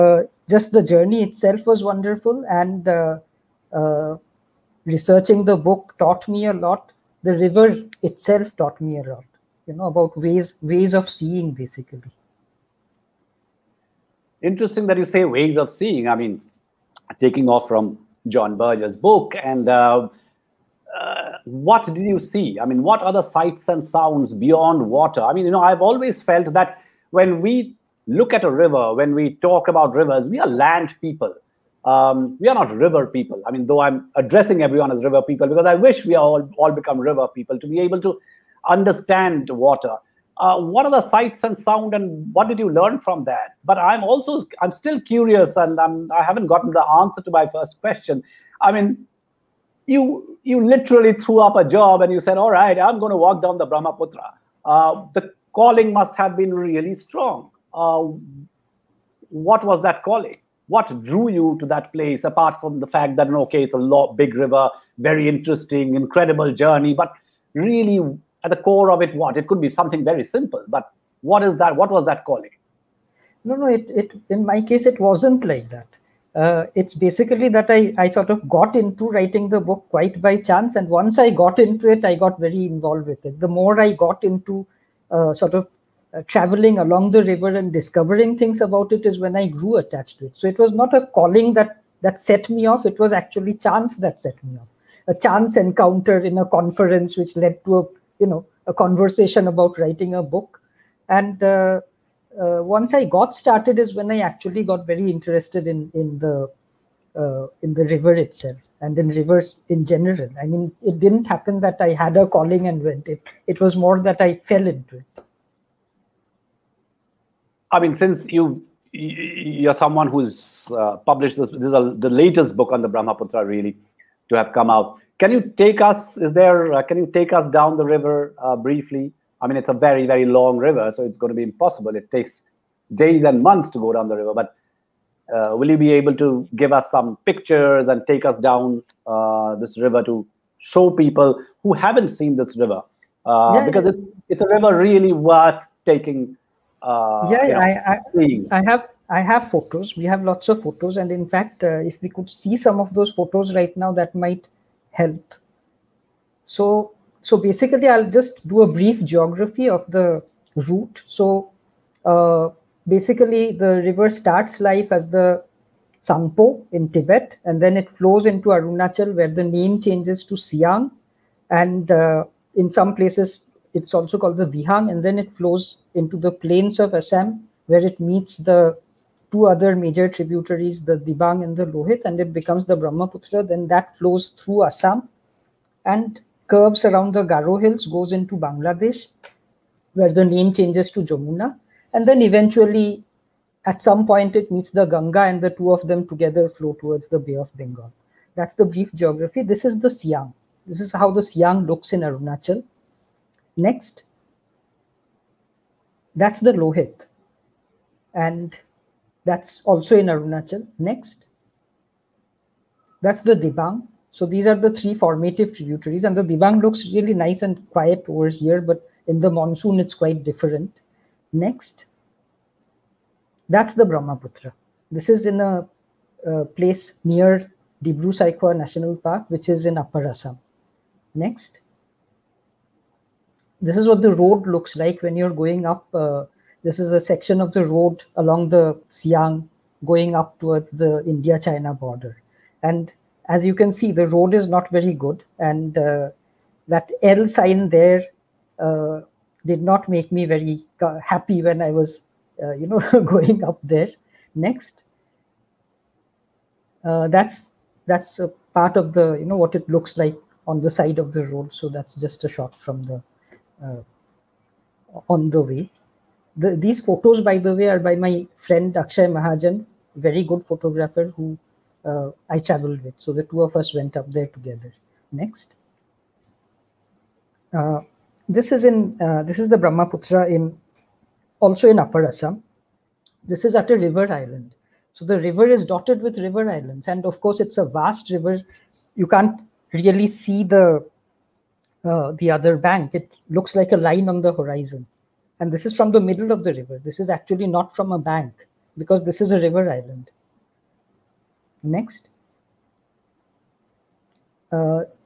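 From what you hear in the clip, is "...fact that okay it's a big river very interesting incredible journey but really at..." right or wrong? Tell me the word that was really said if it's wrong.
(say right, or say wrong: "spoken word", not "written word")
right.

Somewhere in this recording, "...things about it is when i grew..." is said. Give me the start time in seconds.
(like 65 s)
88 s.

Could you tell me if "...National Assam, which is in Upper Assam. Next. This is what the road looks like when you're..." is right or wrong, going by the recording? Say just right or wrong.
wrong.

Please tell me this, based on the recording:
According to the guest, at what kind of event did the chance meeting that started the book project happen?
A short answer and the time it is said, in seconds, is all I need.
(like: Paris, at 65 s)
A conference, at 96 s.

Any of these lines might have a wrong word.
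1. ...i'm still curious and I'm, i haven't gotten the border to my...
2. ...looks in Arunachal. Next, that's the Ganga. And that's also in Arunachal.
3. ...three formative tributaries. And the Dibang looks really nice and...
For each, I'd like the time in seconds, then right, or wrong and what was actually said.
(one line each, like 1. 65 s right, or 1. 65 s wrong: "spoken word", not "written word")
1. 44 s wrong: "answer", not "border"
2. 201 s wrong: "Lohit", not "Ganga"
3. 214 s right.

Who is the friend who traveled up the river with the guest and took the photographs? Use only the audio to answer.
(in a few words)
Akshay Mahajan.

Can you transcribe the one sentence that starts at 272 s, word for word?
So the two of us went up there together.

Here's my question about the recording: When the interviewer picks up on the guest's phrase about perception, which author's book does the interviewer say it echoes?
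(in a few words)
John Berger.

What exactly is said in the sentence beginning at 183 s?
Then that flows through Assam and curves around the Garo Hills, goes into Bangladesh, where the name changes to Jamuna.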